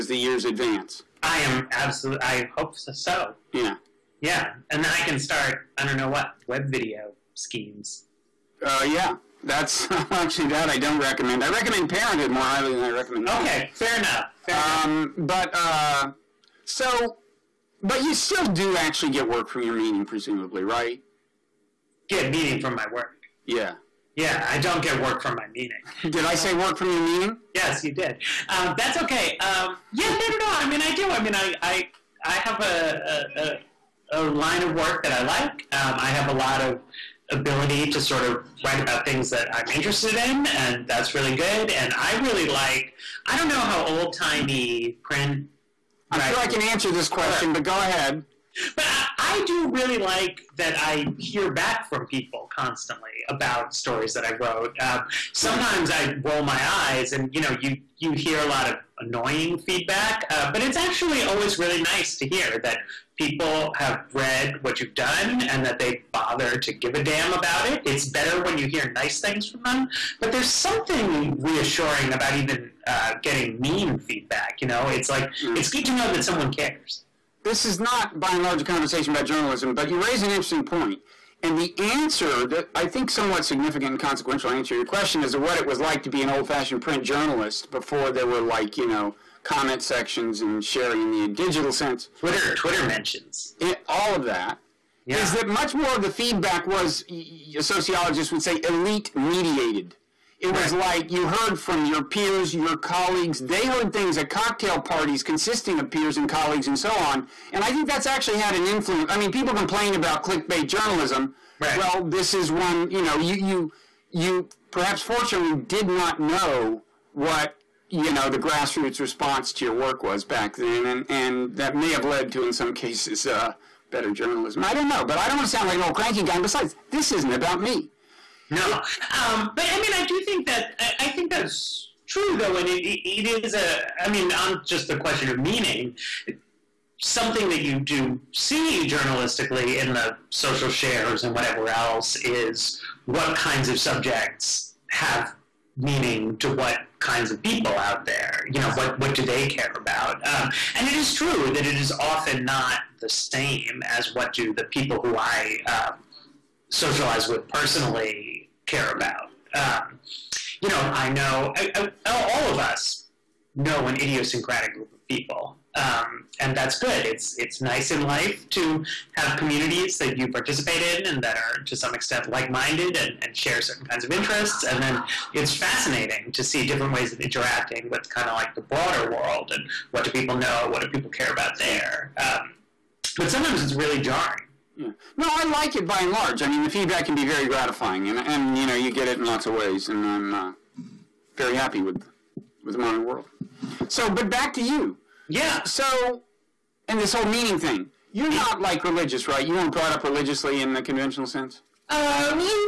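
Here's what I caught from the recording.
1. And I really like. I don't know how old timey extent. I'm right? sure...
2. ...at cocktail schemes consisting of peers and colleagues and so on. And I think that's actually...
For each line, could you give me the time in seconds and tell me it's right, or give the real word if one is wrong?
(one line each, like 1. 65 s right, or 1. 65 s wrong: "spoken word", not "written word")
1. 41 s wrong: "print", not "extent"
2. 104 s wrong: "parties", not "schemes".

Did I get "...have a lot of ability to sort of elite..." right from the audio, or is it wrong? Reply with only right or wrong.
wrong.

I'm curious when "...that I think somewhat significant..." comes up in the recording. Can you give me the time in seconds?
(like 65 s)
82 s.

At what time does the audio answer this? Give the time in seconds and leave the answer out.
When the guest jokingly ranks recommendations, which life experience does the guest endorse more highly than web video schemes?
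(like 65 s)
11 s.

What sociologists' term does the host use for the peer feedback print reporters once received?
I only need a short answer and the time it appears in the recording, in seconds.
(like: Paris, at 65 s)
Elite mediated, at 98 s.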